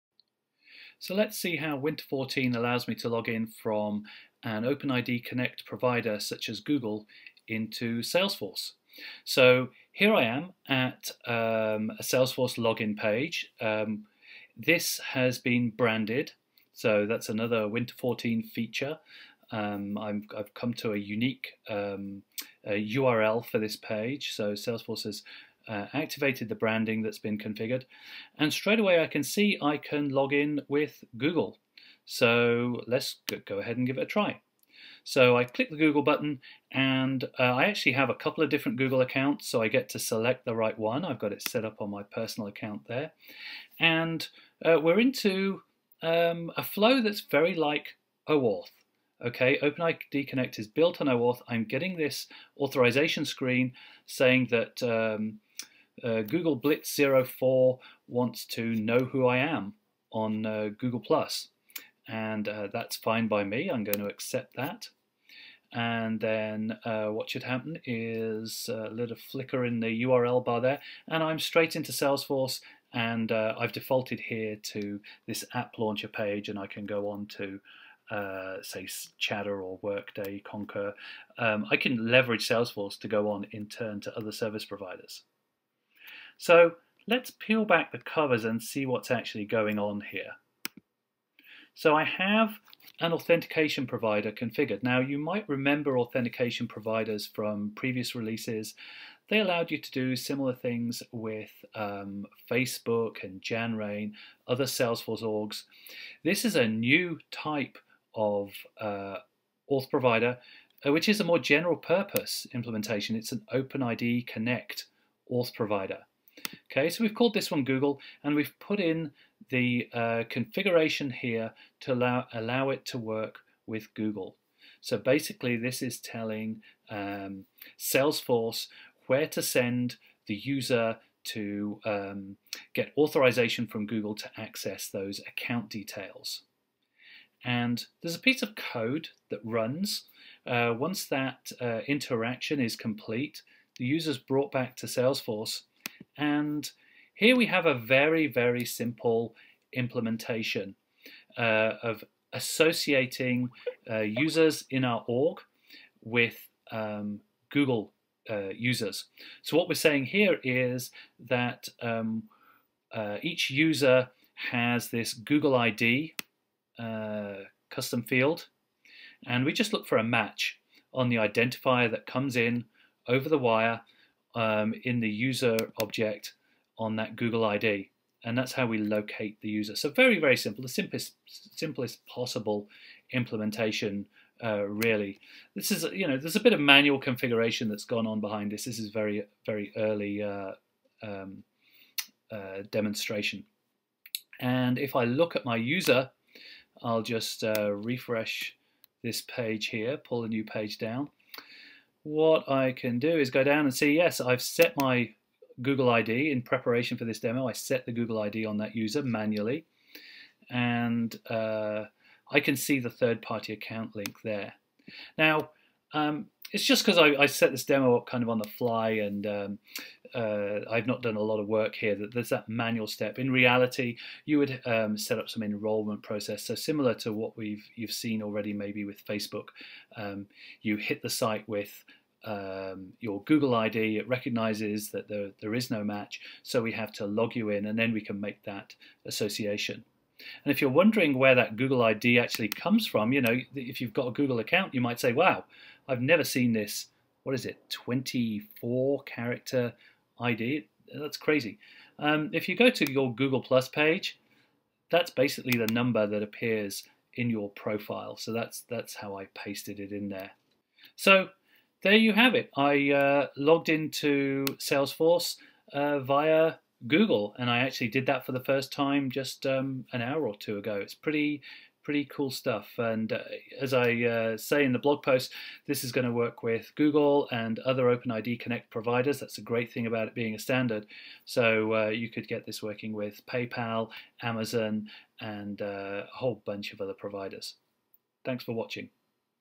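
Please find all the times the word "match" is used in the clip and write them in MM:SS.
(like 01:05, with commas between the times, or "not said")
02:50, 03:55.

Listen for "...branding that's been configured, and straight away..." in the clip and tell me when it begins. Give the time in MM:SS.
00:26.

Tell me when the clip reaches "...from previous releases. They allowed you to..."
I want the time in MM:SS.
01:37.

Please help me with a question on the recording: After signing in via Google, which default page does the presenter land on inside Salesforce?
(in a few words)
app launcher.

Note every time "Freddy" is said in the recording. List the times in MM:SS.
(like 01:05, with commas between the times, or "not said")
not said.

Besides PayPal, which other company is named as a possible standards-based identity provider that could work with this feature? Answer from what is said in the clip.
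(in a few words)
Amazon.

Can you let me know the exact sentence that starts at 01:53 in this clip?
It's an OpenID Connect auth provider.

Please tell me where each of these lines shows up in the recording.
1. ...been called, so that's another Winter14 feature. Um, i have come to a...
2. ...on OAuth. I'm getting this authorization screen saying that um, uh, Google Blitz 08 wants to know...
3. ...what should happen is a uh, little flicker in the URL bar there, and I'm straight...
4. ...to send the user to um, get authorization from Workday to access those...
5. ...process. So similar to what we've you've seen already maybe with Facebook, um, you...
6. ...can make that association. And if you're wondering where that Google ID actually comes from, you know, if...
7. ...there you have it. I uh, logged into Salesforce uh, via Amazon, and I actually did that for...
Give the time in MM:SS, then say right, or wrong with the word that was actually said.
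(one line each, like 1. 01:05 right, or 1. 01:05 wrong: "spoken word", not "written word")
1. 00:15 wrong: "branded", not "called"
2. 00:51 wrong: "04", not "08"
3. 01:07 right
4. 02:09 wrong: "Google", not "Workday"
5. 03:46 right
6. 03:58 right
7. 04:21 wrong: "Google", not "Amazon".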